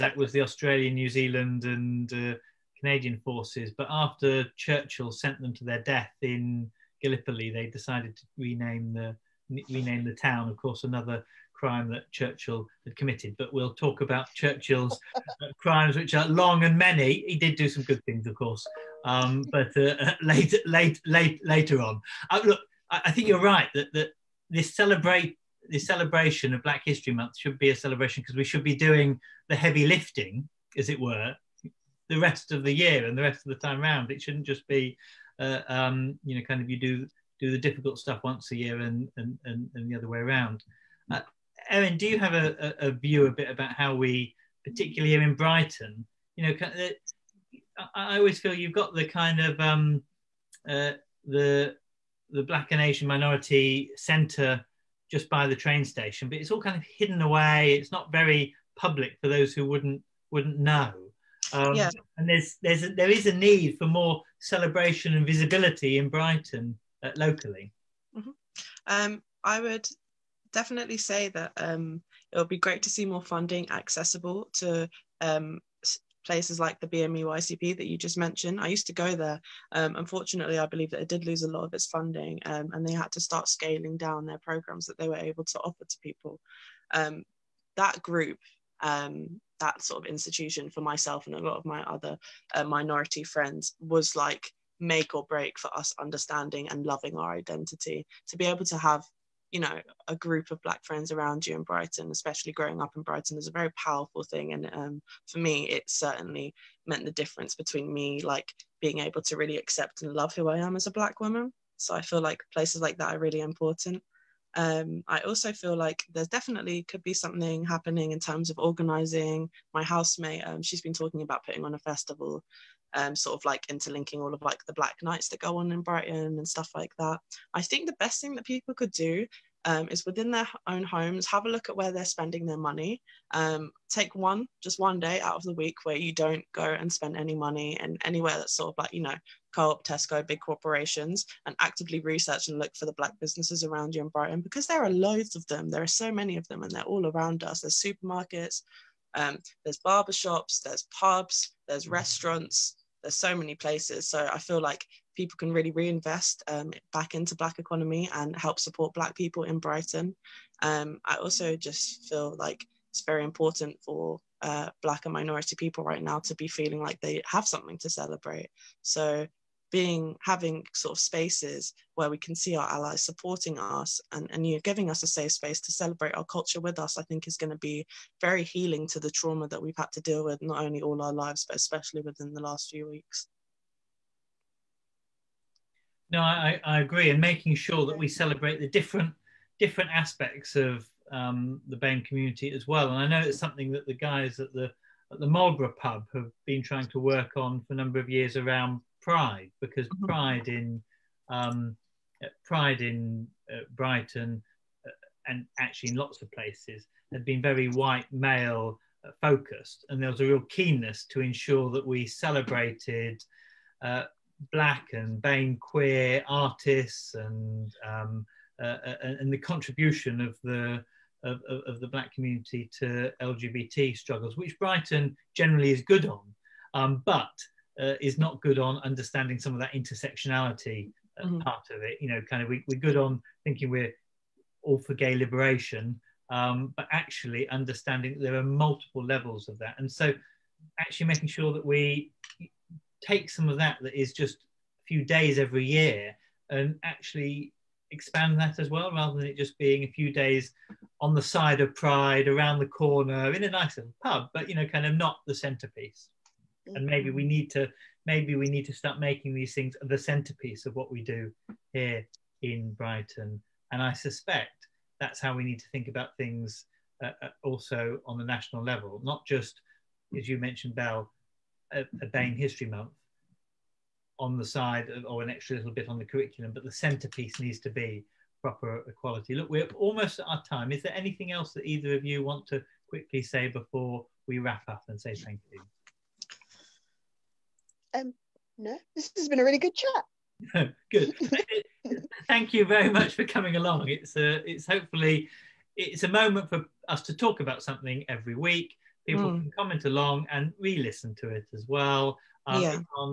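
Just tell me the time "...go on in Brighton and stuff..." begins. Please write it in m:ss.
2:05.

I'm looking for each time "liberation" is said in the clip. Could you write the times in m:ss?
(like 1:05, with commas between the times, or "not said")
3:55.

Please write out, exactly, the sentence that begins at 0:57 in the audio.
It's not very public for those who wouldn't wouldn't know.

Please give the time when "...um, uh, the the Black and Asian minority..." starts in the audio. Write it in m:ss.
0:49.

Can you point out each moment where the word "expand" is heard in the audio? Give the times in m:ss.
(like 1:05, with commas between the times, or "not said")
4:07.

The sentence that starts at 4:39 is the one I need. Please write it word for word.
Look, we're almost at our time.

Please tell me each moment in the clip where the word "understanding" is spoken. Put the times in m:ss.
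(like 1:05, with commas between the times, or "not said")
1:36, 3:48, 3:57.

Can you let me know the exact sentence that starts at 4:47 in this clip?
um, no, this has been a really good chat.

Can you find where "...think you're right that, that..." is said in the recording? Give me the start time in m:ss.
0:23.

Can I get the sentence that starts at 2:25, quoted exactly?
There are so many of them and they're all around us.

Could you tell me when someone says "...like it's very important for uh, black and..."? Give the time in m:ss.
2:42.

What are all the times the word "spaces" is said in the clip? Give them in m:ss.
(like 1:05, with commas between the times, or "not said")
2:51, 2:55.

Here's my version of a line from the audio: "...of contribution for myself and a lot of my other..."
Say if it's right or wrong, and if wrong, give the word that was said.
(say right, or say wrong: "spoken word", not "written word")
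wrong: "institution", not "contribution".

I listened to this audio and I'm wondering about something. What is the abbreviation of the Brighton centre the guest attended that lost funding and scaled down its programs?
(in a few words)
YCP.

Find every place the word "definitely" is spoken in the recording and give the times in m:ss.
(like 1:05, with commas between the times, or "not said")
1:10, 1:56.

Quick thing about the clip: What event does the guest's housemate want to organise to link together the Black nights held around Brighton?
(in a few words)
a festival.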